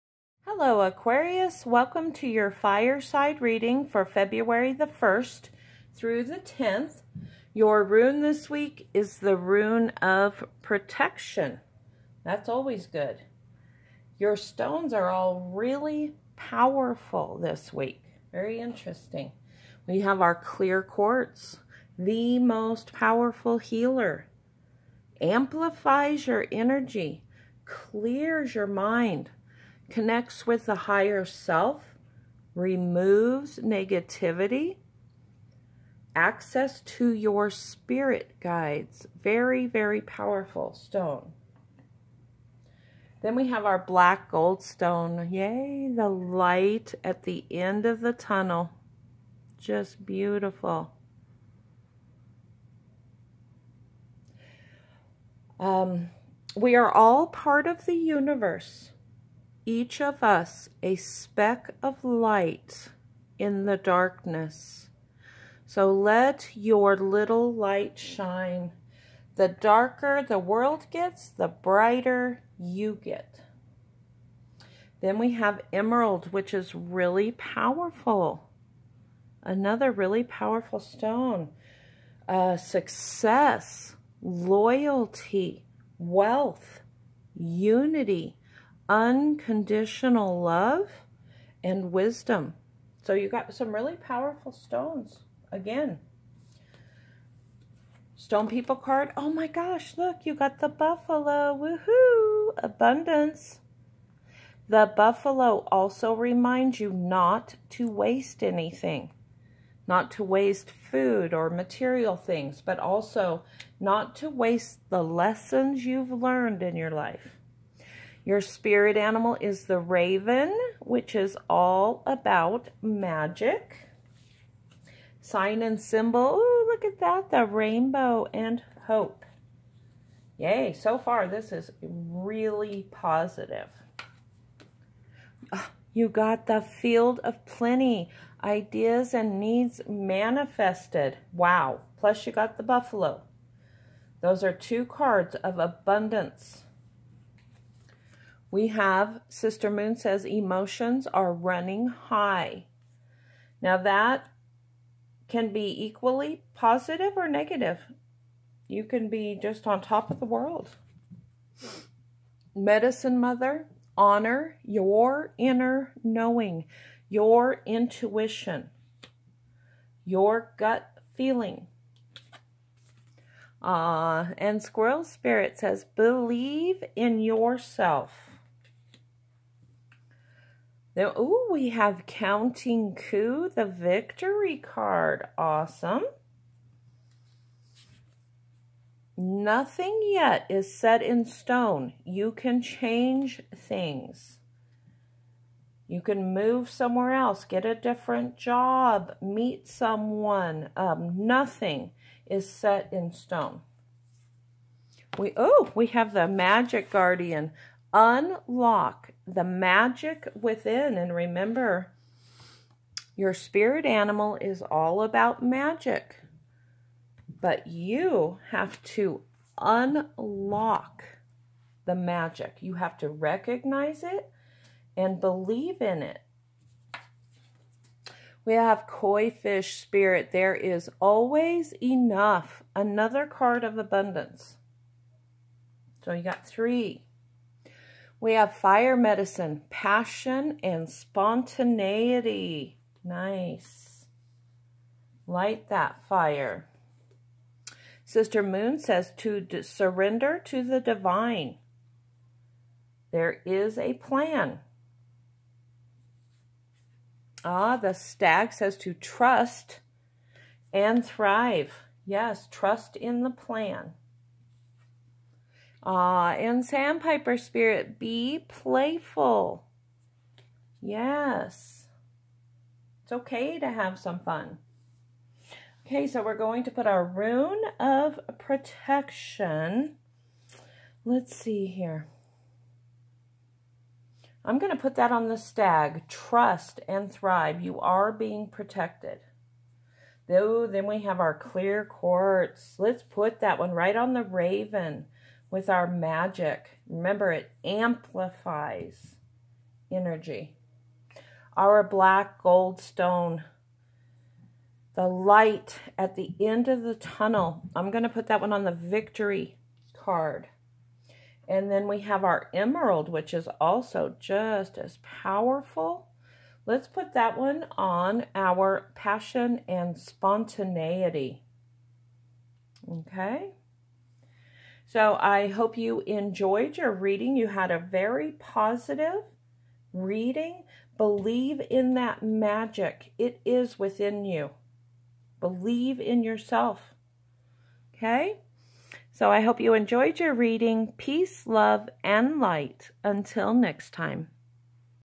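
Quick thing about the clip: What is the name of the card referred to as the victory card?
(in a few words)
Counting Coup.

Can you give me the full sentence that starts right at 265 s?
Ah, and sandpiper spirit, be playful.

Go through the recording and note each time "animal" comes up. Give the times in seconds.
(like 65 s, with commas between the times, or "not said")
118 s, 213 s.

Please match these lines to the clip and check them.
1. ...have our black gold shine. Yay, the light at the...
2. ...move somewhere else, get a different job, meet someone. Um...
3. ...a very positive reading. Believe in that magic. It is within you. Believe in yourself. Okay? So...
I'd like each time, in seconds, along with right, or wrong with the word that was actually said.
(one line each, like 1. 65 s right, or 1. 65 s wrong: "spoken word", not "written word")
1. 43 s wrong: "stone", not "shine"
2. 196 s right
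3. 327 s right.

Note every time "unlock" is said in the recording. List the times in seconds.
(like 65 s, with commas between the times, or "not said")
207 s, 219 s.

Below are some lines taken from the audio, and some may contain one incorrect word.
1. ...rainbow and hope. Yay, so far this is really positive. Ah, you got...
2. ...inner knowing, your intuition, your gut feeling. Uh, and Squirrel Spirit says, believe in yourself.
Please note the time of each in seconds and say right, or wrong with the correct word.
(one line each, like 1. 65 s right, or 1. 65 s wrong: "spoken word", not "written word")
1. 127 s right
2. 165 s right.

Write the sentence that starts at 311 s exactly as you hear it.
And then we have our emerald, which is also just as powerful.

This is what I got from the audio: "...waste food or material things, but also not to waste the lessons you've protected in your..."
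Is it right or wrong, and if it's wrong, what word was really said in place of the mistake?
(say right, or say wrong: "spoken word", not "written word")
wrong: "learned", not "protected".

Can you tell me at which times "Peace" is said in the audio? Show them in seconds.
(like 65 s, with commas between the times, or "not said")
340 s.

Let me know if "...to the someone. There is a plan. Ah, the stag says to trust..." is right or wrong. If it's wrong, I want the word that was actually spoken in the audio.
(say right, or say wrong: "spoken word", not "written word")
wrong: "divine", not "someone".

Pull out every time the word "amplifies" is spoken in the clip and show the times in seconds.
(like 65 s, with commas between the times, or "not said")
25 s, 297 s.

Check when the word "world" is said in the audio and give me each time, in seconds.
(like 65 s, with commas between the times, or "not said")
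70 s, 160 s.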